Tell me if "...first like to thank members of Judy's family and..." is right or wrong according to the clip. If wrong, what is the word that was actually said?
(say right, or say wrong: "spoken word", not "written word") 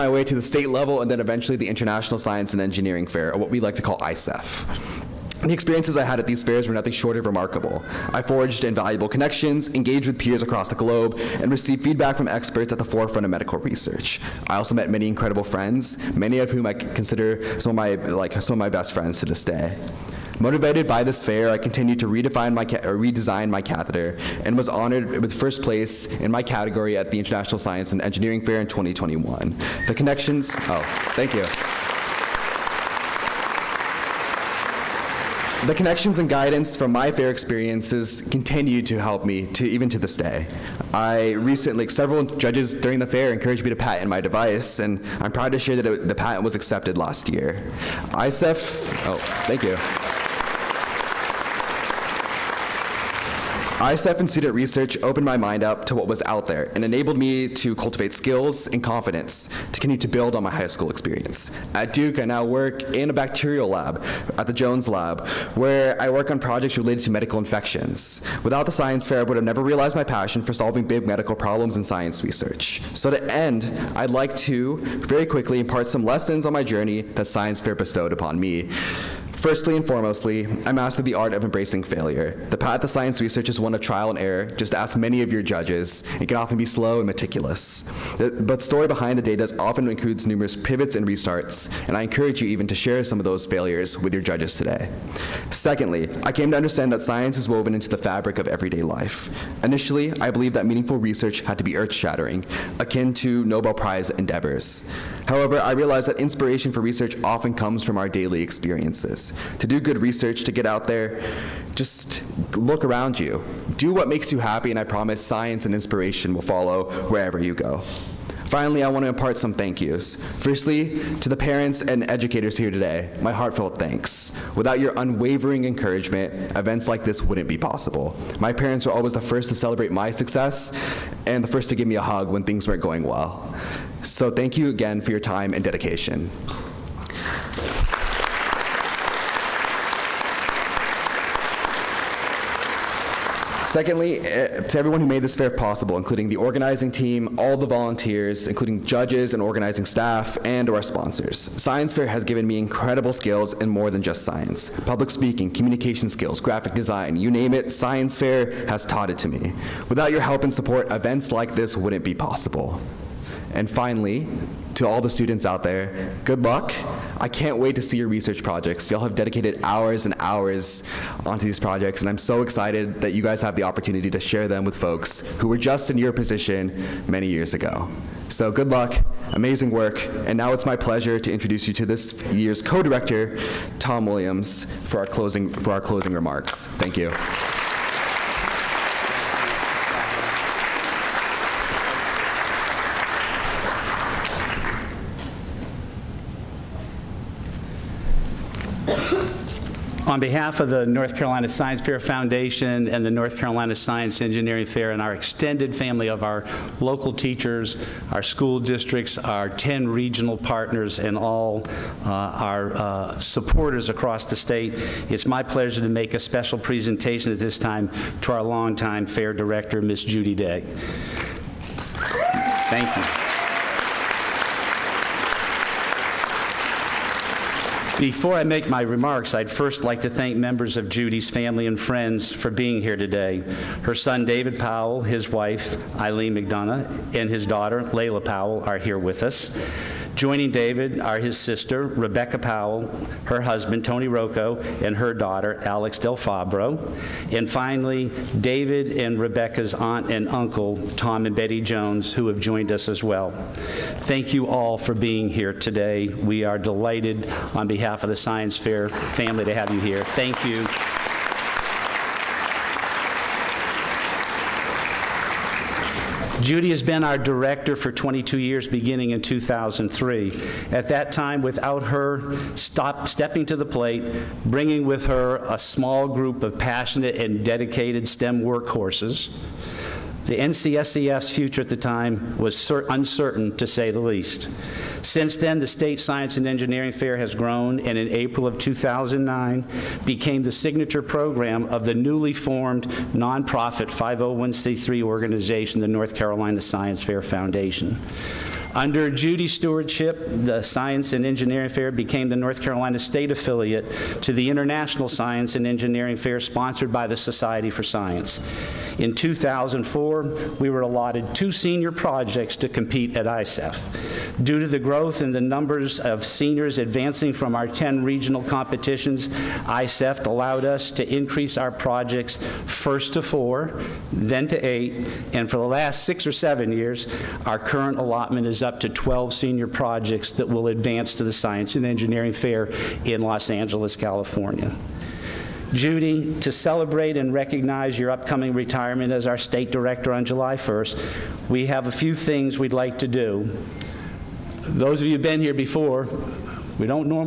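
right.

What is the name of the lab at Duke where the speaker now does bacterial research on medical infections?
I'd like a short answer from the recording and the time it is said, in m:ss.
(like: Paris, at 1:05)
Jones Lab, at 1:04.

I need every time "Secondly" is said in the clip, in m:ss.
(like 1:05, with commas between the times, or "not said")
1:35, 2:23.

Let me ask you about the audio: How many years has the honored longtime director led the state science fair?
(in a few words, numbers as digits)
22.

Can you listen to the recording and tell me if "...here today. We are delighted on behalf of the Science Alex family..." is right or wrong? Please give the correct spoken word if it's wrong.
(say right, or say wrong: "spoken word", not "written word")
wrong: "Fair", not "Alex".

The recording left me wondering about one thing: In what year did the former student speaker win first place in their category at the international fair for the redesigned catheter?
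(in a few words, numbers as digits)
2021.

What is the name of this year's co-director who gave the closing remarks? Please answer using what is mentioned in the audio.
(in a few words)
Tom Williams.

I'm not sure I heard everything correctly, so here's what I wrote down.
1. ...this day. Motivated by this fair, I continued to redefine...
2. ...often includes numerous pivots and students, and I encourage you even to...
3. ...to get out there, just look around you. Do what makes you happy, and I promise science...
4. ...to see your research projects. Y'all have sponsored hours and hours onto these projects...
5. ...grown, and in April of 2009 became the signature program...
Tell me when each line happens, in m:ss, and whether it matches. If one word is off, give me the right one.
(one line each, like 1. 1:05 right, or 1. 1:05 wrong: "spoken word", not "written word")
1. 0:19 right
2. 1:29 wrong: "restarts", not "students"
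3. 1:50 right
4. 2:47 wrong: "dedicated", not "sponsored"
5. 4:47 right.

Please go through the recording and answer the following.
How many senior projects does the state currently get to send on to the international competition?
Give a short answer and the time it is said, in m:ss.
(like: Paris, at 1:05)
12, at 5:28.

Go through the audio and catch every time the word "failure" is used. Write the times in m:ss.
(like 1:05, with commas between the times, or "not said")
1:21, 1:33.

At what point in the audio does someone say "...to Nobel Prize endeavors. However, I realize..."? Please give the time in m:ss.
1:43.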